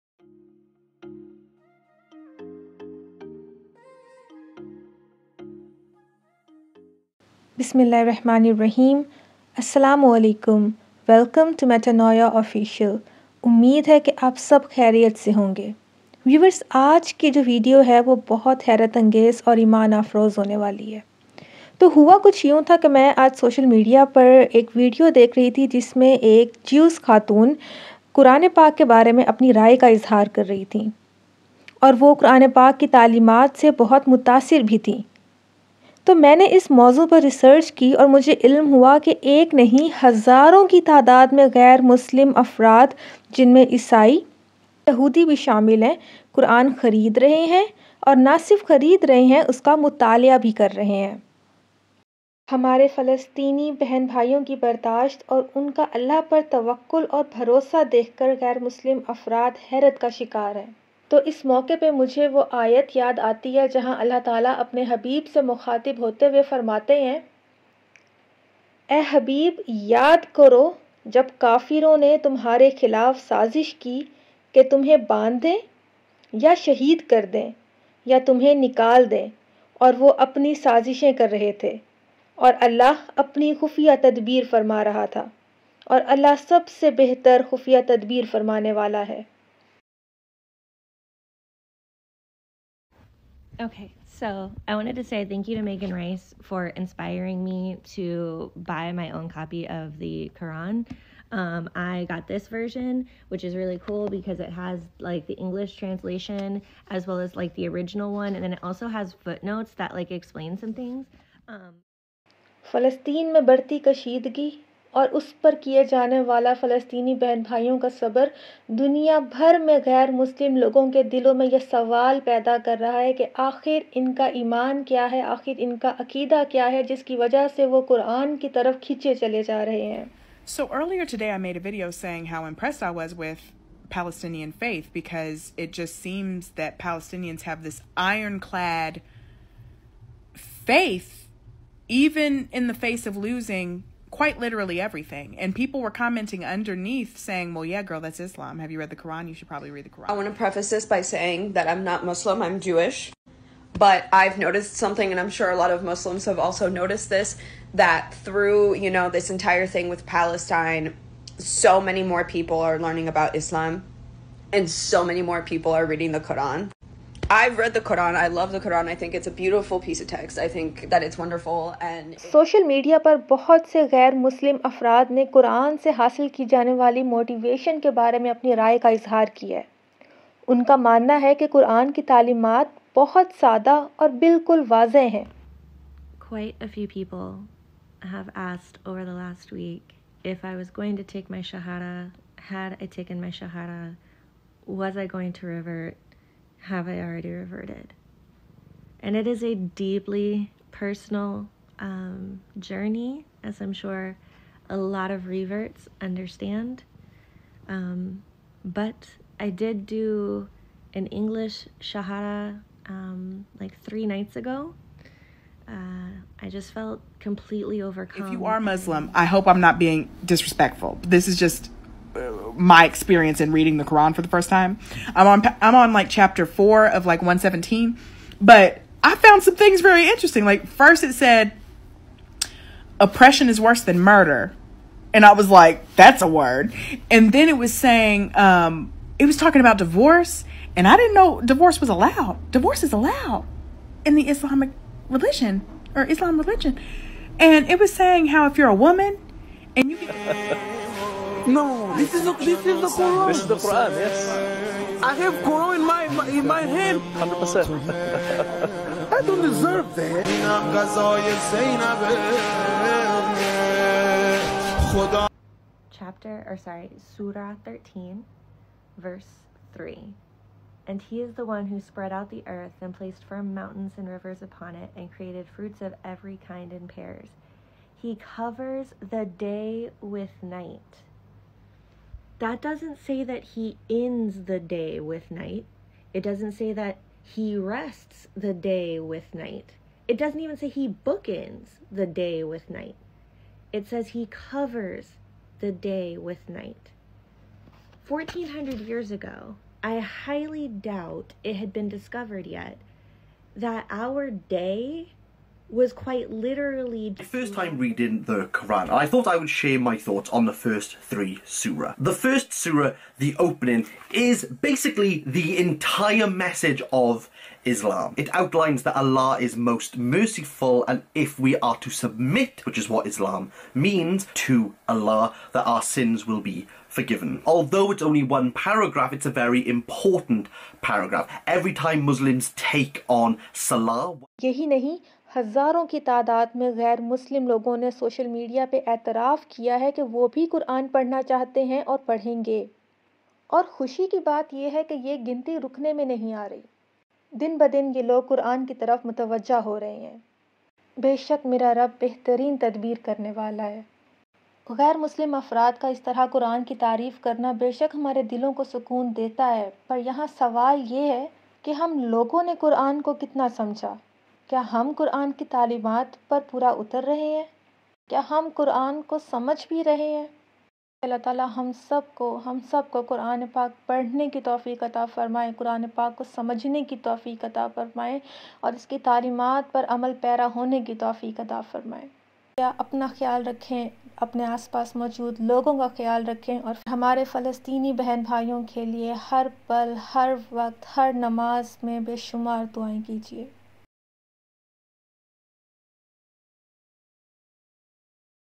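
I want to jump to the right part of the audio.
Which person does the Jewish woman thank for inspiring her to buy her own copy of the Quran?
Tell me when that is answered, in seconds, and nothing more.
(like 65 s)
95 s.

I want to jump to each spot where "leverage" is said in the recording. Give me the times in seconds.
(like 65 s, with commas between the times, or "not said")
not said.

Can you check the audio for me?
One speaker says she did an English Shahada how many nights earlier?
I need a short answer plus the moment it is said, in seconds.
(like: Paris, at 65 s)
3 nights ago, at 213 s.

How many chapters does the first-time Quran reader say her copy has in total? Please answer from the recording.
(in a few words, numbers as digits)
117.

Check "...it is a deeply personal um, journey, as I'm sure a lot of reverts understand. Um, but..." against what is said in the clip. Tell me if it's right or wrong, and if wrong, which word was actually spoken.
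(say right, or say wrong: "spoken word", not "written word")
right.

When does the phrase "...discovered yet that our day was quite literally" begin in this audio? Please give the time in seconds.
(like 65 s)
301 s.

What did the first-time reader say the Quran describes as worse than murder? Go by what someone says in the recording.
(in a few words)
Oppression.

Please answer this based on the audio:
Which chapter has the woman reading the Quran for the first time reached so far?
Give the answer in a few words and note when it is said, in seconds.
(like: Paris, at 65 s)
Chapter 4, at 226 s.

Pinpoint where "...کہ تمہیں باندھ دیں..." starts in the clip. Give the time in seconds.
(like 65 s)
74 s.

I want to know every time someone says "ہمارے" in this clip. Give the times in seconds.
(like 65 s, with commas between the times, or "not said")
52 s, 357 s, 386 s.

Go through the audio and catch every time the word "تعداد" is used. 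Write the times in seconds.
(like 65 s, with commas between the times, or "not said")
40 s, 336 s.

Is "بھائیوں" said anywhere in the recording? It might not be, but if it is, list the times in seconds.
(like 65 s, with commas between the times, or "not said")
54 s, 117 s, 388 s.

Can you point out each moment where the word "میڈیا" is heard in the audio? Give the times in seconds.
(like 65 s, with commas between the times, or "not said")
23 s, 338 s.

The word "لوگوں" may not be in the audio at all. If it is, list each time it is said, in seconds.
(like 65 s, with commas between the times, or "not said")
120 s, 337 s, 362 s, 385 s.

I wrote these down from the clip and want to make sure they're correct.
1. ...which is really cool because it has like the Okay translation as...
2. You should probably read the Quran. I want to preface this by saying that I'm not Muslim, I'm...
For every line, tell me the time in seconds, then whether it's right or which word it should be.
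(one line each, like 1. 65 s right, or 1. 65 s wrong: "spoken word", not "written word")
1. 103 s wrong: "English", not "Okay"
2. 149 s right.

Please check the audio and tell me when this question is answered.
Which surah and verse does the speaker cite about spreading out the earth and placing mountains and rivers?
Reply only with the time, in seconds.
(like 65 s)
267 s.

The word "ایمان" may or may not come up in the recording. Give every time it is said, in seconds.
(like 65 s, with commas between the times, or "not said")
19 s, 124 s.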